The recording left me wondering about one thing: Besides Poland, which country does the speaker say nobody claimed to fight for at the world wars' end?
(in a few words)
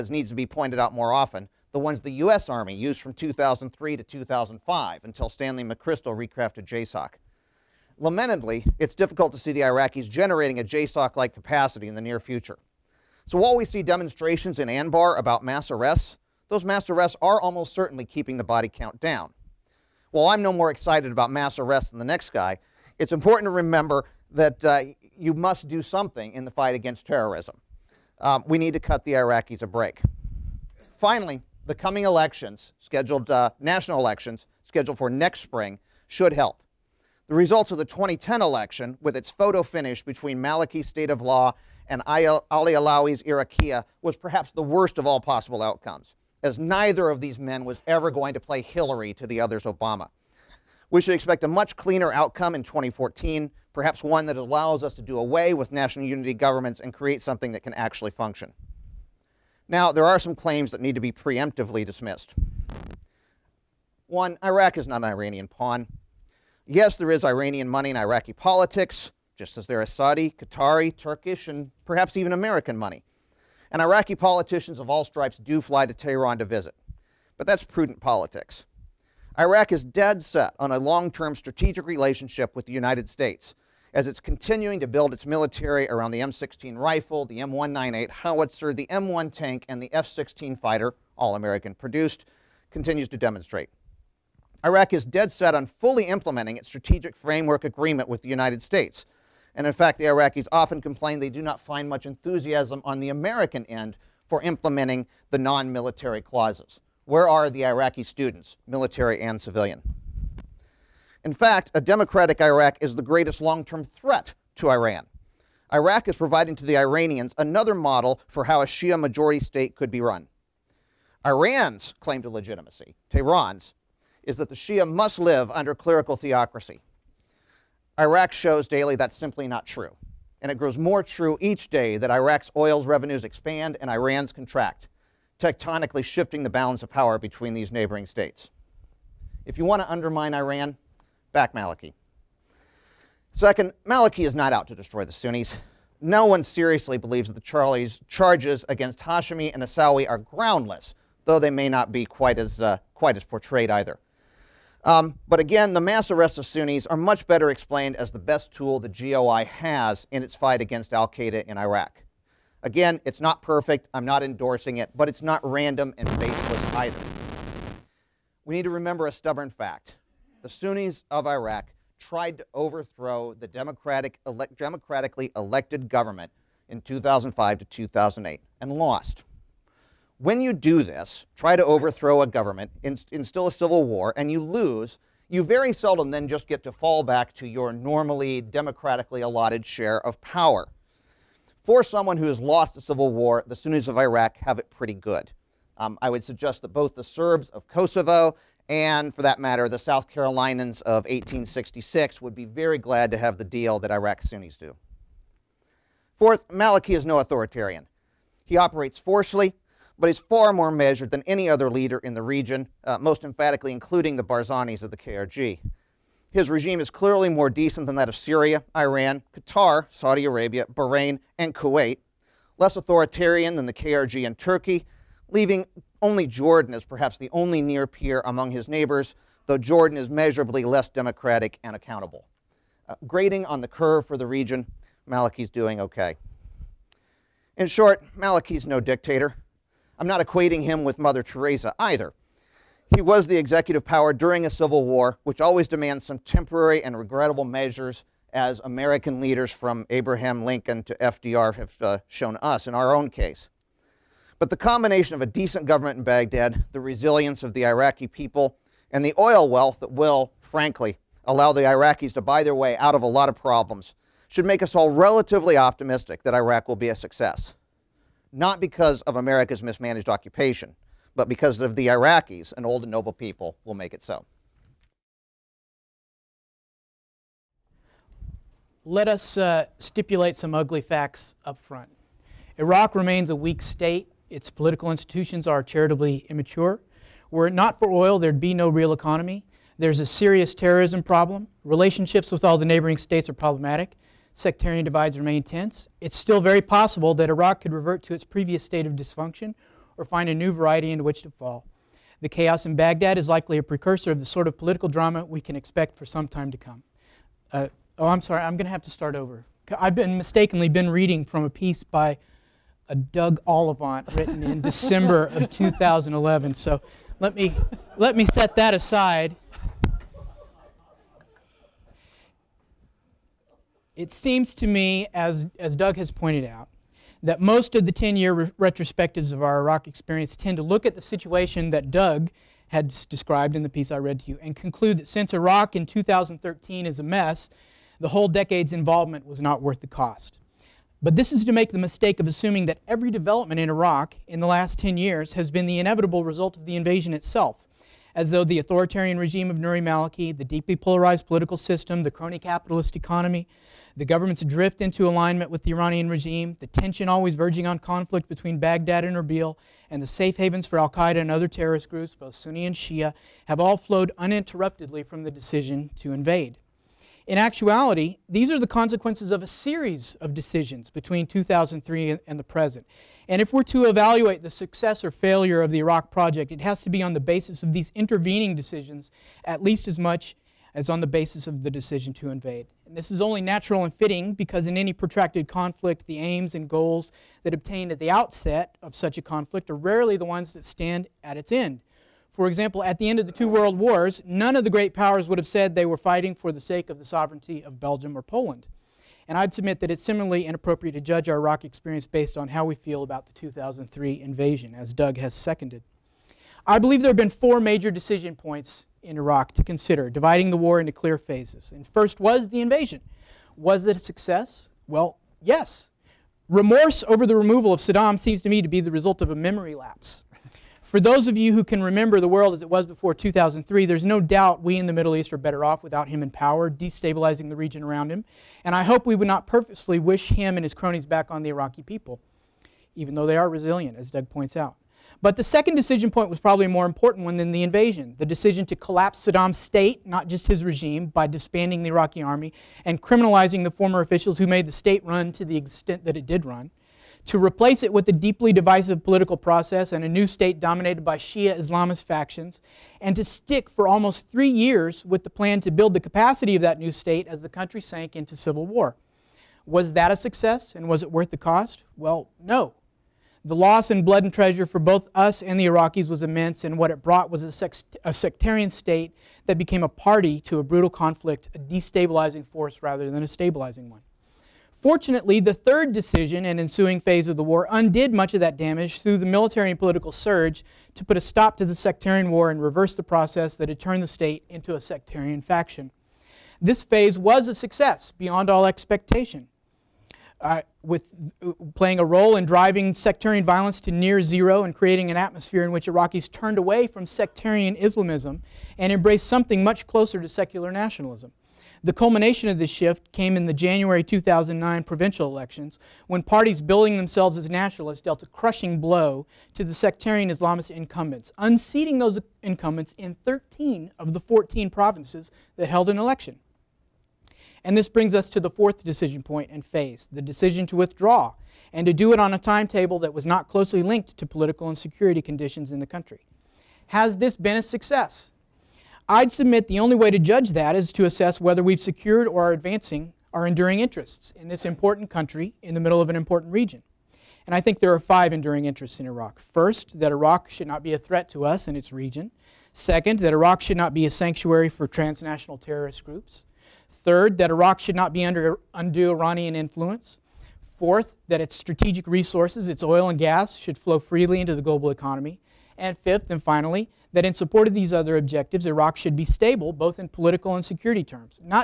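Belgium.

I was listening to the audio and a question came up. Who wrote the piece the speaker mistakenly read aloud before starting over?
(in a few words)
Doug Ollivant.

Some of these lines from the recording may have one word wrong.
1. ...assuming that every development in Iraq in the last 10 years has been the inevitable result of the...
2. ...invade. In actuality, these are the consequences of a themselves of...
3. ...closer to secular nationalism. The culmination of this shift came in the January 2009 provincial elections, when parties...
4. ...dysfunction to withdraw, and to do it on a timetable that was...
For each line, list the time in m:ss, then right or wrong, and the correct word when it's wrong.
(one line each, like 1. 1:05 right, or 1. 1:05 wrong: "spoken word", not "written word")
1. 5:42 right
2. 6:06 wrong: "series", not "themselves"
3. 8:19 right
4. 8:40 wrong: "decision", not "dysfunction".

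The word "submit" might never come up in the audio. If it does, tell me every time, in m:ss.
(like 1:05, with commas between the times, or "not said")
6:39, 8:49.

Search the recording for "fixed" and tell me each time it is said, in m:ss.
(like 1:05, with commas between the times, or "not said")
not said.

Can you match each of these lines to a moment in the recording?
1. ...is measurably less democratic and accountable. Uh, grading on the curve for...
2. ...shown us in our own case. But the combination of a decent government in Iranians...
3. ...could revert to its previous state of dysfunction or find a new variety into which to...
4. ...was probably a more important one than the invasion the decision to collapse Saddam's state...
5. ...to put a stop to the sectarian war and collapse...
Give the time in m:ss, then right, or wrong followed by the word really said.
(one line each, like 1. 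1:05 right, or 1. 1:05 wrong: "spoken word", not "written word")
1. 3:49 right
2. 4:12 wrong: "Baghdad", not "Iranians"
3. 4:57 right
4. 7:16 right
5. 8:00 wrong: "reverse", not "collapse".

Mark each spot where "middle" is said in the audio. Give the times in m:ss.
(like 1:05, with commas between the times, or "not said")
7:04, 8:55.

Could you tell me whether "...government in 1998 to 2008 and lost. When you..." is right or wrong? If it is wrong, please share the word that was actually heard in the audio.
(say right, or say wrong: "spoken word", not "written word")
wrong: "2005", not "1998".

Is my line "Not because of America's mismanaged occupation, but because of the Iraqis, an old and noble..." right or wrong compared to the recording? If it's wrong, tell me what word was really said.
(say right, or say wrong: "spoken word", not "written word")
right.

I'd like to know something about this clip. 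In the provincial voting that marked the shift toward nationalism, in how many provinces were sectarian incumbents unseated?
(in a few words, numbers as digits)
13.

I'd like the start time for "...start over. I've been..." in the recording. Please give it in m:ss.
5:08.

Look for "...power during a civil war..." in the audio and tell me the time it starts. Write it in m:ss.
4:03.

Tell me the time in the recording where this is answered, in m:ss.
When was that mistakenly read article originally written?
5:14.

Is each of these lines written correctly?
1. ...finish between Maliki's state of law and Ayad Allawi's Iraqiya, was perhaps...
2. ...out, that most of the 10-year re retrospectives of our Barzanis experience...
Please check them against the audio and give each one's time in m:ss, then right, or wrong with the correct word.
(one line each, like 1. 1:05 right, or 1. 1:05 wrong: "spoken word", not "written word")
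1. 0:39 right
2. 5:26 wrong: "Iraq", not "Barzanis".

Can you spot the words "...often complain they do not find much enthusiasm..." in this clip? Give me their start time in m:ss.
1:40.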